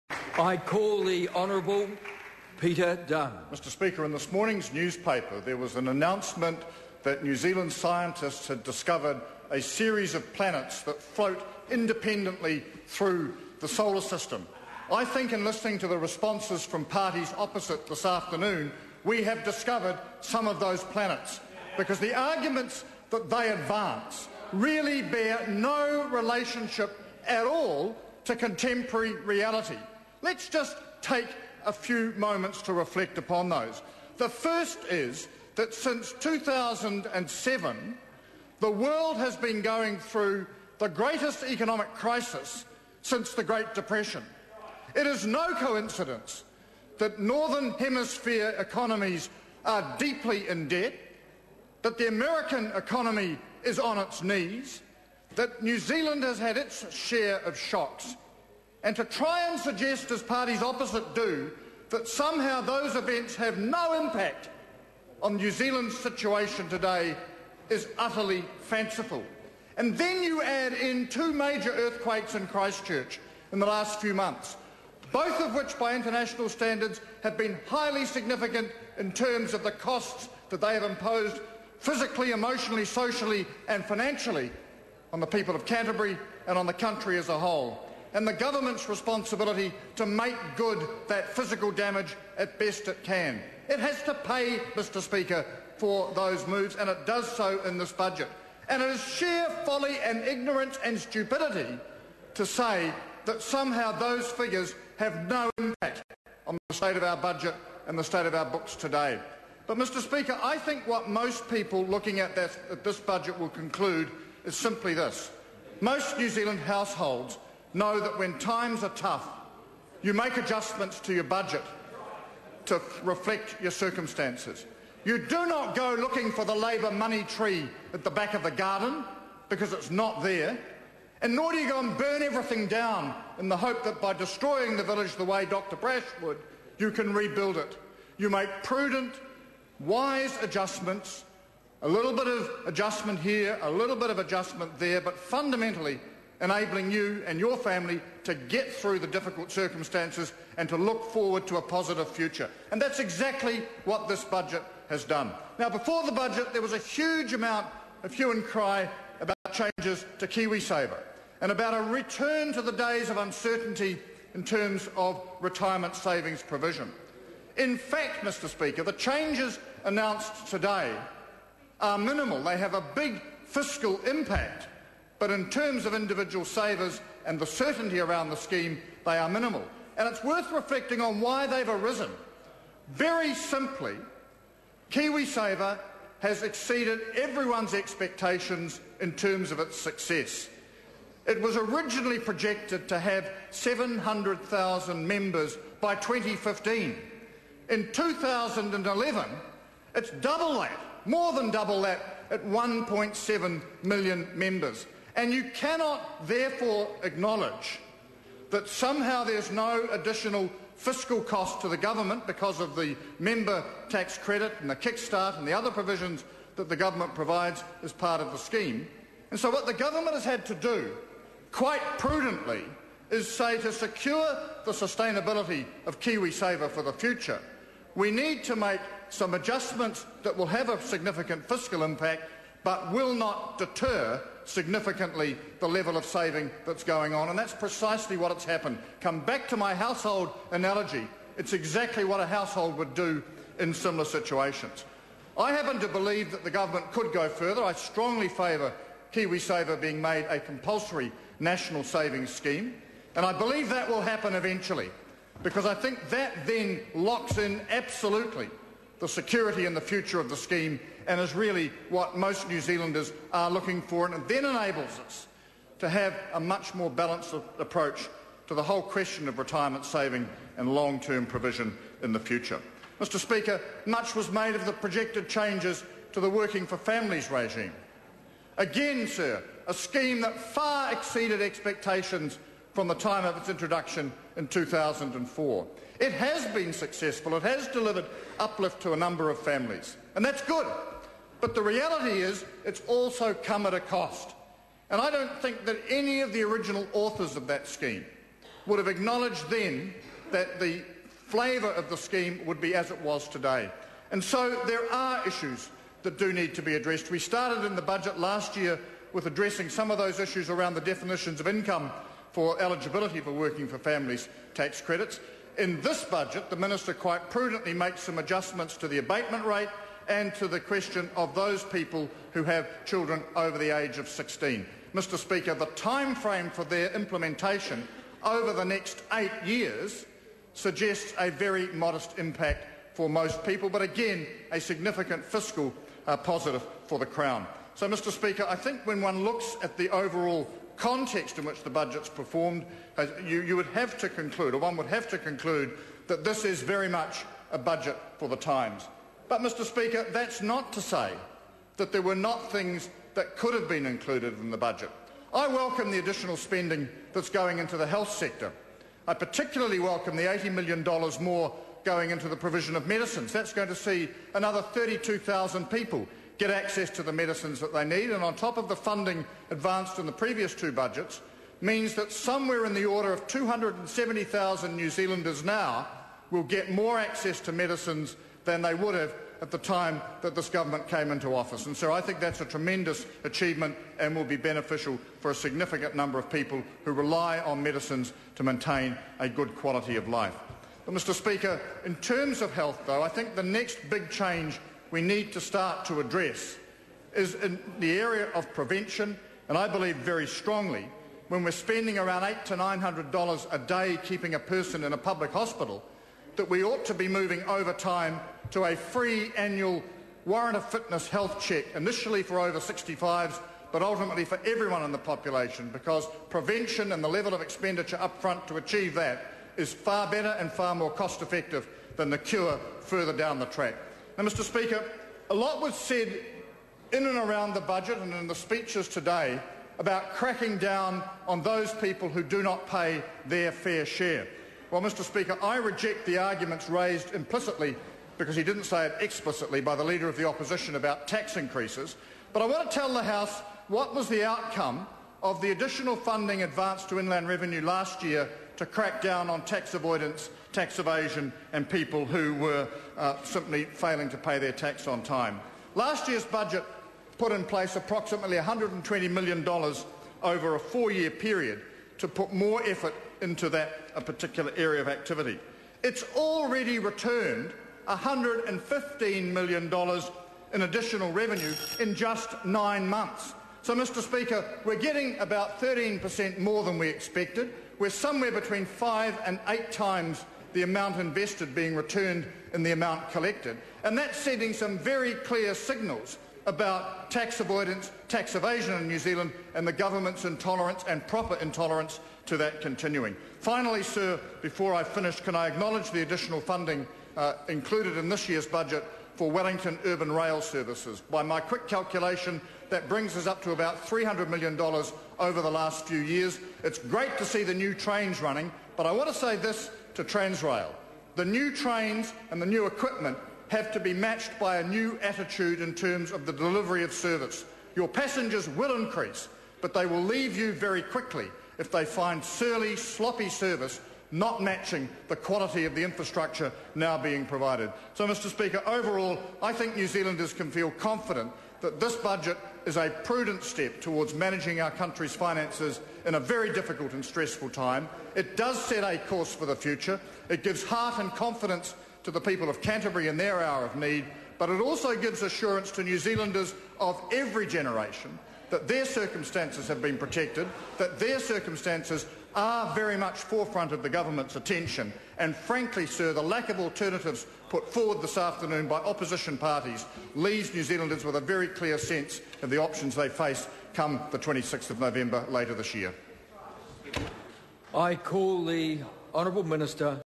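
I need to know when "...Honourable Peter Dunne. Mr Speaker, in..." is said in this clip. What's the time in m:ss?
0:01.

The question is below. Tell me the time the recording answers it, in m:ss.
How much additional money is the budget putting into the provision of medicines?
6:00.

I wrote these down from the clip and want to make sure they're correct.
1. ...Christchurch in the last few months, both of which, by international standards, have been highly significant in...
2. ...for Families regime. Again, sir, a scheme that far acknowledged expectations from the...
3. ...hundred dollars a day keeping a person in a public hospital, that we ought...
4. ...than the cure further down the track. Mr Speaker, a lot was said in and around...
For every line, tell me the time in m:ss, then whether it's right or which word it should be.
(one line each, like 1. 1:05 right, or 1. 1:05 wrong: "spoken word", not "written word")
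1. 1:12 right
2. 4:36 wrong: "exceeded", not "acknowledged"
3. 6:42 right
4. 7:01 right.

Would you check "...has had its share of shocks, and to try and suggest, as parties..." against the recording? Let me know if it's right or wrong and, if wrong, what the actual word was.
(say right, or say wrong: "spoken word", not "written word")
right.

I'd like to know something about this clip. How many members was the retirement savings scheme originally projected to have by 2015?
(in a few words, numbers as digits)
700,000.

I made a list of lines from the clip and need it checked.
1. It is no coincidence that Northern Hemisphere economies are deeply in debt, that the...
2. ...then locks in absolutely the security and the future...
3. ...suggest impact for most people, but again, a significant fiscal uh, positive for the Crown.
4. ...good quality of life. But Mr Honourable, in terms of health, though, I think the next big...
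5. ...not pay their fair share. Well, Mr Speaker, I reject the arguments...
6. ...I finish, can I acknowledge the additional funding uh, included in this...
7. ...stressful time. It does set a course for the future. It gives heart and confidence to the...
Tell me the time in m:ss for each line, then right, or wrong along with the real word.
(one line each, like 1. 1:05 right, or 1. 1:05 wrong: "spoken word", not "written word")
1. 0:44 right
2. 4:16 right
3. 5:31 wrong: "modest", not "suggest"
4. 6:29 wrong: "Speaker", not "Honourable"
5. 7:12 right
6. 8:14 right
7. 8:57 right.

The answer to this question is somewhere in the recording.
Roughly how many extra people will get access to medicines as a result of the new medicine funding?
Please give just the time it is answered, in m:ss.
6:04.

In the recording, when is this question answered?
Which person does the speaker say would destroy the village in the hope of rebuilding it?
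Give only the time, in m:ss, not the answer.
2:15.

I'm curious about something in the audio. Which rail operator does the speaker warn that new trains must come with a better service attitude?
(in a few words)
Transrail.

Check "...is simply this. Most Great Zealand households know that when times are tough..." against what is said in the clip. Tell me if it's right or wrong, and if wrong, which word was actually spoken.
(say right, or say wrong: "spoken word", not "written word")
wrong: "New", not "Great".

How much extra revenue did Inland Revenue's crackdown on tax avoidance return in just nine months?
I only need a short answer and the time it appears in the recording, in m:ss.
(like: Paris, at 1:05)
$115 million, at 7:47.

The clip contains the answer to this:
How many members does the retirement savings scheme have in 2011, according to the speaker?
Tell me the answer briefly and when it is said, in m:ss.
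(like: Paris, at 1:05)
1.7 million, at 3:22.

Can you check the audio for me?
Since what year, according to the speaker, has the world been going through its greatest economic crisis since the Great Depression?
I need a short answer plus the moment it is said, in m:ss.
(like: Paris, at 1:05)
2007, at 0:36.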